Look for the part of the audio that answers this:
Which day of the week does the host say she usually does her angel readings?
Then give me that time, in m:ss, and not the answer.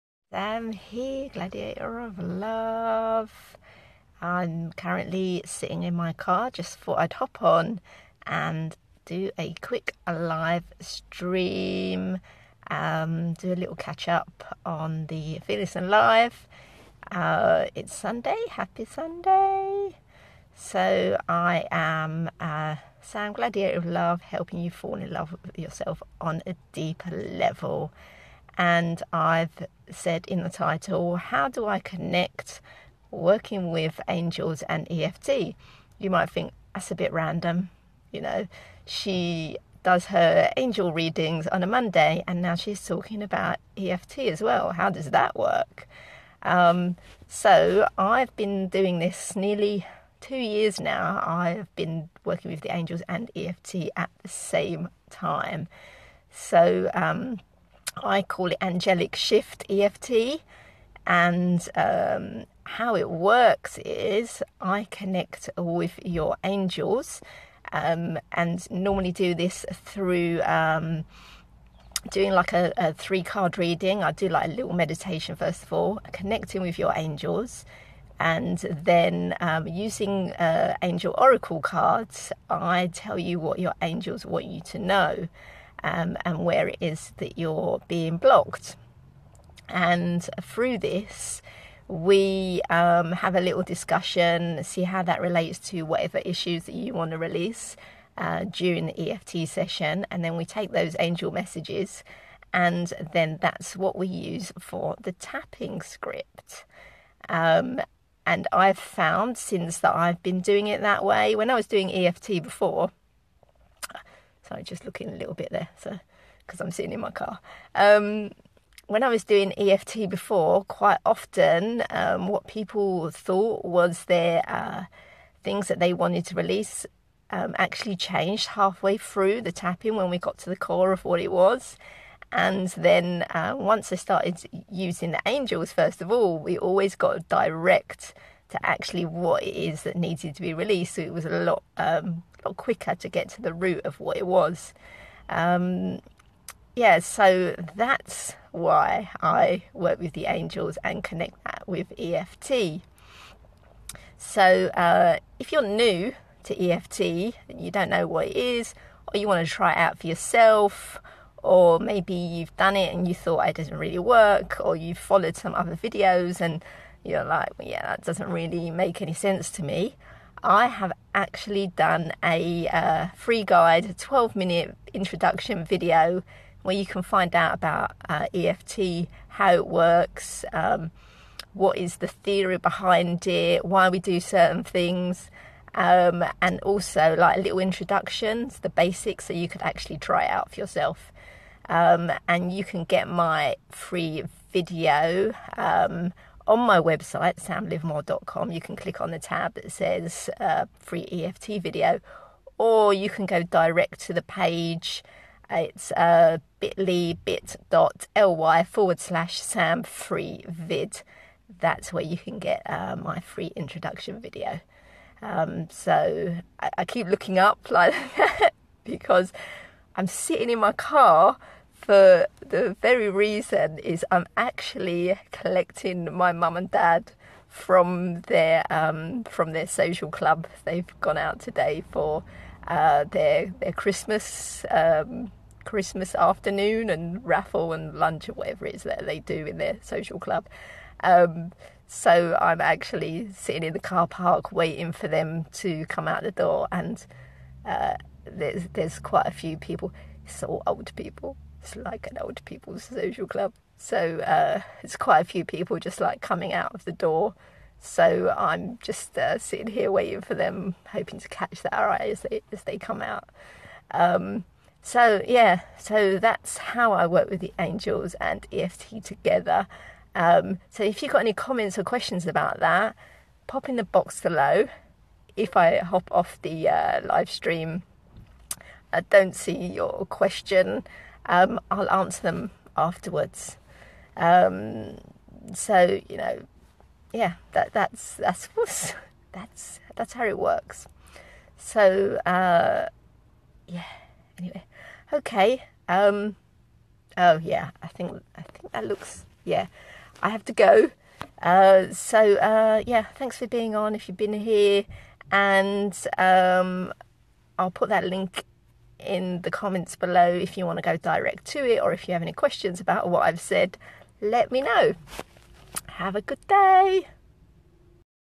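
0:41.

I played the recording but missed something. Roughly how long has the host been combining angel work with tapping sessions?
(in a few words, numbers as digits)
Nearly two years.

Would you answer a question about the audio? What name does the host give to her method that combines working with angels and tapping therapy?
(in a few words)
Angelic shift EFT.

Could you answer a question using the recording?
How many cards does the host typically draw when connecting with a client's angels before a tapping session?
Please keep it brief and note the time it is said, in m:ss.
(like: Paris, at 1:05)
3, at 1:12.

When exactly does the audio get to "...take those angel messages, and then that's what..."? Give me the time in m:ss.
1:40.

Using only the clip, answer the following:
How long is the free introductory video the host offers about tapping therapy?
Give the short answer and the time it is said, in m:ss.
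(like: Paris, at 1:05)
12 minutes, at 2:53.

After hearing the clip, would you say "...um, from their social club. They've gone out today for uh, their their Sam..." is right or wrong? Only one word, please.
wrong.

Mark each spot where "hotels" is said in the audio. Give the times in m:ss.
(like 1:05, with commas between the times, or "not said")
not said.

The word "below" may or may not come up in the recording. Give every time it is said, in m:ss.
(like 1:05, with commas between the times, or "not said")
4:34, 5:09.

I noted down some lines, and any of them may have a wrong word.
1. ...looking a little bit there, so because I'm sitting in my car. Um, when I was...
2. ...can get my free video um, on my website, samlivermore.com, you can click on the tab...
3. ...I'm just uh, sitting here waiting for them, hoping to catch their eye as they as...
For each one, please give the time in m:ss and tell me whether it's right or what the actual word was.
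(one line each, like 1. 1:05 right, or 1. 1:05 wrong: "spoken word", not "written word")
1. 1:54 right
2. 3:12 right
3. 4:18 right.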